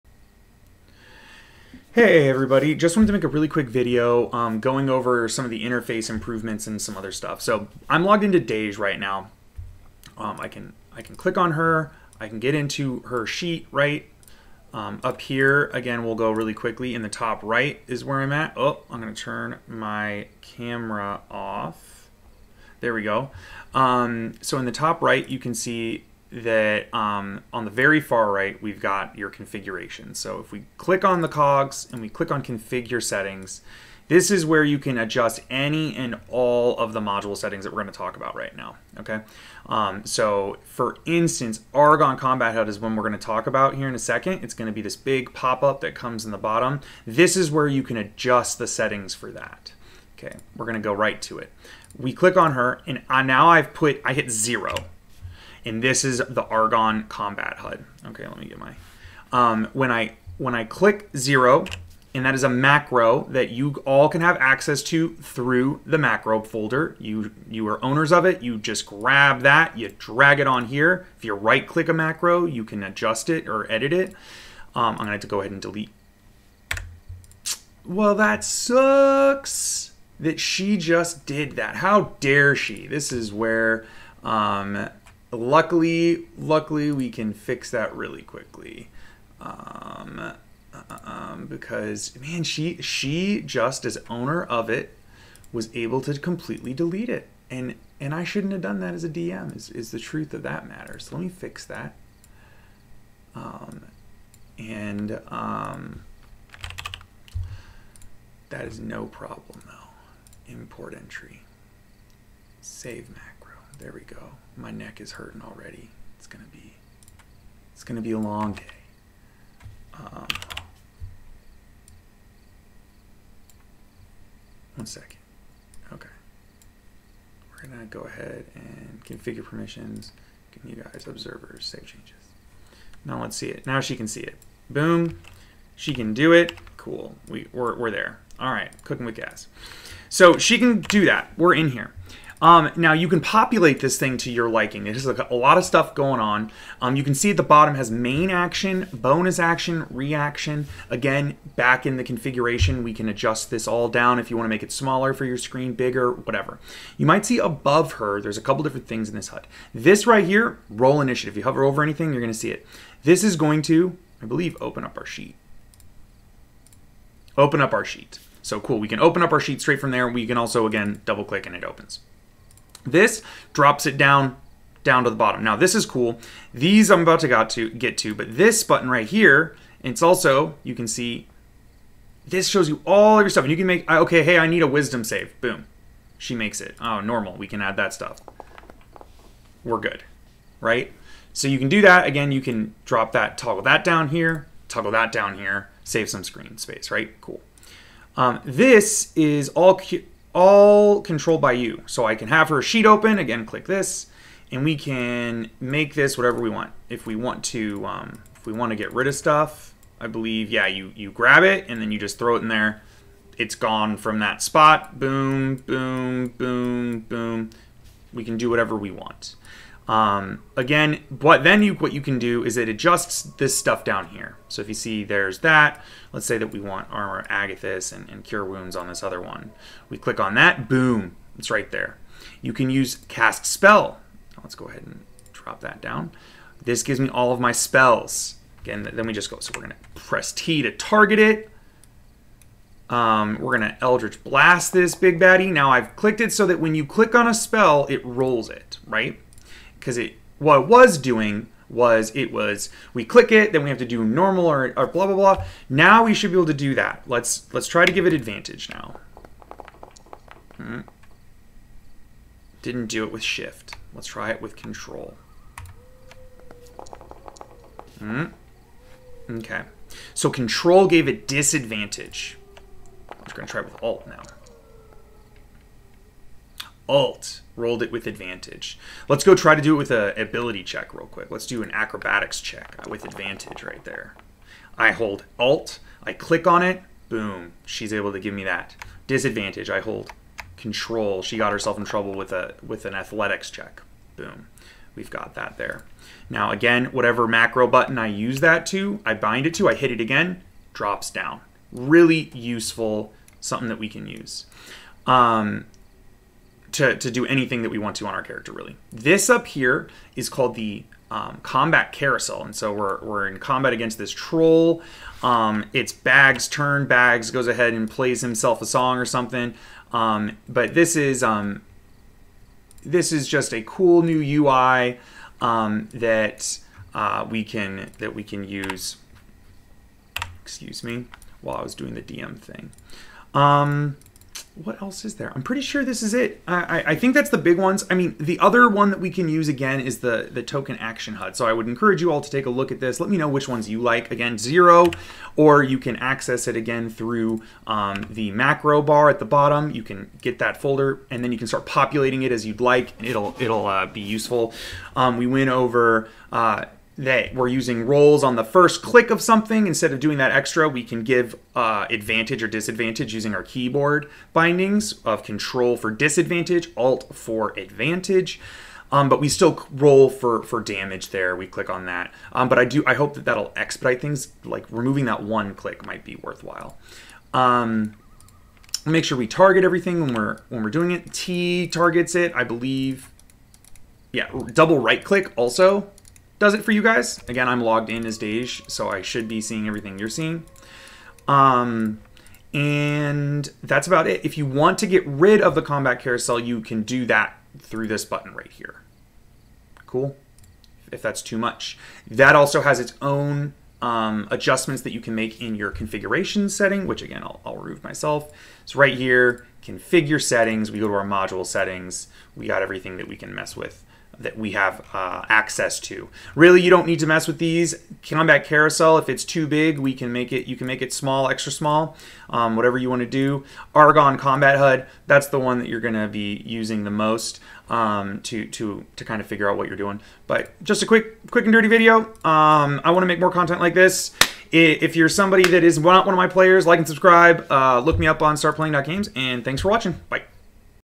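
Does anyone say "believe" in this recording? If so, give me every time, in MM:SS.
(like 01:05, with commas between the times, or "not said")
02:44, 03:30, 06:22.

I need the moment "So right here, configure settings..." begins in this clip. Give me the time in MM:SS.
06:48.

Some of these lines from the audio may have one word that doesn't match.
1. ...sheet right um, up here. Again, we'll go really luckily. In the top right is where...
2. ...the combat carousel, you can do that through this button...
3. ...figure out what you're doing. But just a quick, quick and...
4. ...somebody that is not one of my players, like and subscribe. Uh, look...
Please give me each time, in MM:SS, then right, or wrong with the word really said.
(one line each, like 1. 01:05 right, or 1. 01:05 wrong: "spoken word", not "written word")
1. 00:13 wrong: "quickly", not "luckily"
2. 06:35 right
3. 07:09 right
4. 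07:15 right.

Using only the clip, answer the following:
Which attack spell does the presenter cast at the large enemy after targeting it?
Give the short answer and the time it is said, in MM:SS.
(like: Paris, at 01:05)
Eldritch Blast, at 04:03.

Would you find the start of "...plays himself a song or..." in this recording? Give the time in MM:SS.
05:17.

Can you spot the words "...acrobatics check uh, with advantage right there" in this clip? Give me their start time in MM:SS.
04:41.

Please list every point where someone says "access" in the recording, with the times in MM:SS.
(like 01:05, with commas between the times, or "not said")
01:04, 05:45, 06:55.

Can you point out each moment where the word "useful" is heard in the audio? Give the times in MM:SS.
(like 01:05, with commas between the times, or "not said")
05:02, 05:54.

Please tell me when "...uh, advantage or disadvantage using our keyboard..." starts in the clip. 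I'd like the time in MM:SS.
06:01.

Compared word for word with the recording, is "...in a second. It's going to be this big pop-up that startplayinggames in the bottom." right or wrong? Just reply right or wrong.
wrong.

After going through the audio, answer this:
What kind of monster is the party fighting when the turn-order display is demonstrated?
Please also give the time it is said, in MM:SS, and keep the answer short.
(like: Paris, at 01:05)
Troll, at 05:14.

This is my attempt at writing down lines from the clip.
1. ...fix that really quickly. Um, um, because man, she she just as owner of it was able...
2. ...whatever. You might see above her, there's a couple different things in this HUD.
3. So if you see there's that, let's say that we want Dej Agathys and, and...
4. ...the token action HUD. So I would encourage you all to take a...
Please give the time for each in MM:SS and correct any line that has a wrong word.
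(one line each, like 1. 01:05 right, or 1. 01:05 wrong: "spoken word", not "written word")
1. 01:27 right
2. 02:36 right
3. 03:44 wrong: "Armor", not "Dej"
4. 05:40 right.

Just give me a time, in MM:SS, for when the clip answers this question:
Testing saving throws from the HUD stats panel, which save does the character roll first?
03:04.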